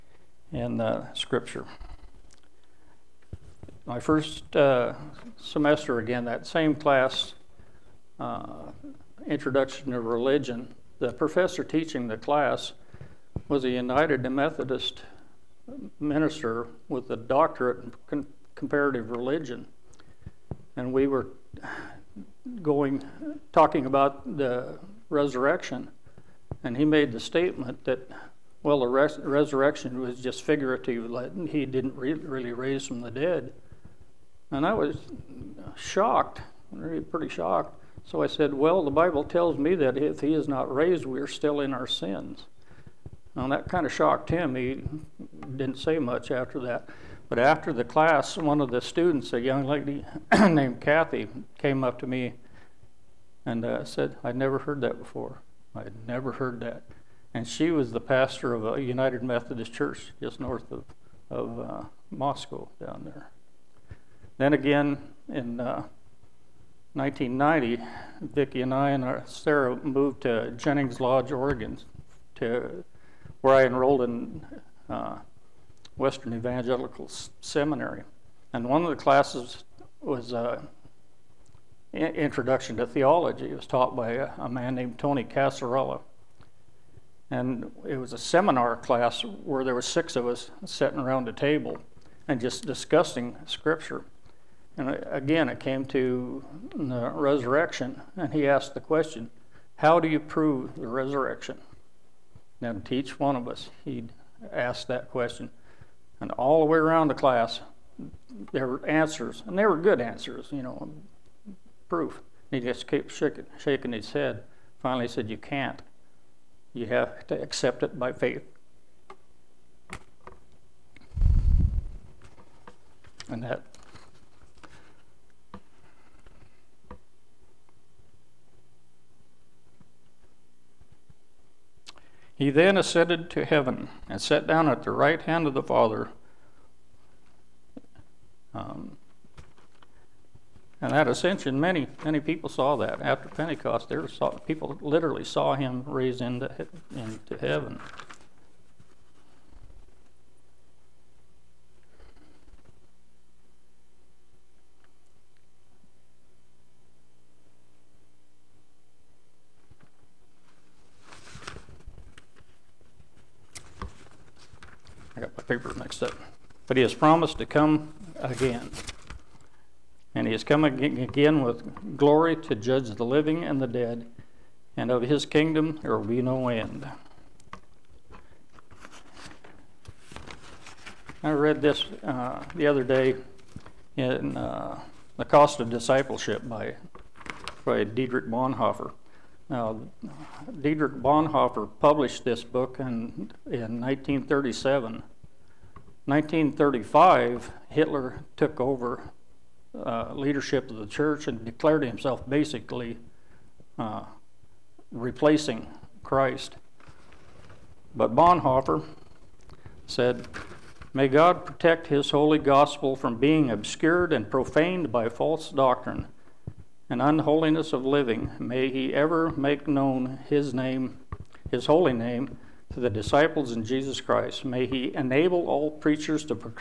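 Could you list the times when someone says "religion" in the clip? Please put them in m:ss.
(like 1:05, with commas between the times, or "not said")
0:10, 0:19.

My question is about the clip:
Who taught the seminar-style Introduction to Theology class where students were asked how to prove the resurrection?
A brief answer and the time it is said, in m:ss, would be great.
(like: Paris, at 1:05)
Tony Casarella, at 1:24.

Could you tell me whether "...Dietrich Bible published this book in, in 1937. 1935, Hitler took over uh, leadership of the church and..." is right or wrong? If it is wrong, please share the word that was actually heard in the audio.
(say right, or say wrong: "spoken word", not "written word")
wrong: "Bonhoeffer", not "Bible".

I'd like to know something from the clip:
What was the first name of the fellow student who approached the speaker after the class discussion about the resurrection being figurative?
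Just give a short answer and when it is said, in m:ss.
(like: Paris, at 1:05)
Kathy, at 0:50.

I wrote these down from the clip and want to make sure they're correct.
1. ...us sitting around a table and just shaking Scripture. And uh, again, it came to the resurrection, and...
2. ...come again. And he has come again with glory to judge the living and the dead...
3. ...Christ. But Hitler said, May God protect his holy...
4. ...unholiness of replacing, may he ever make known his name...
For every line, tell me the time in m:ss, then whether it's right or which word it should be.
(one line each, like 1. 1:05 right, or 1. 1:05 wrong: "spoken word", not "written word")
1. 1:30 wrong: "discussing", not "shaking"
2. 2:47 right
3. 3:26 wrong: "Bonhoeffer", not "Hitler"
4. 3:37 wrong: "living", not "replacing".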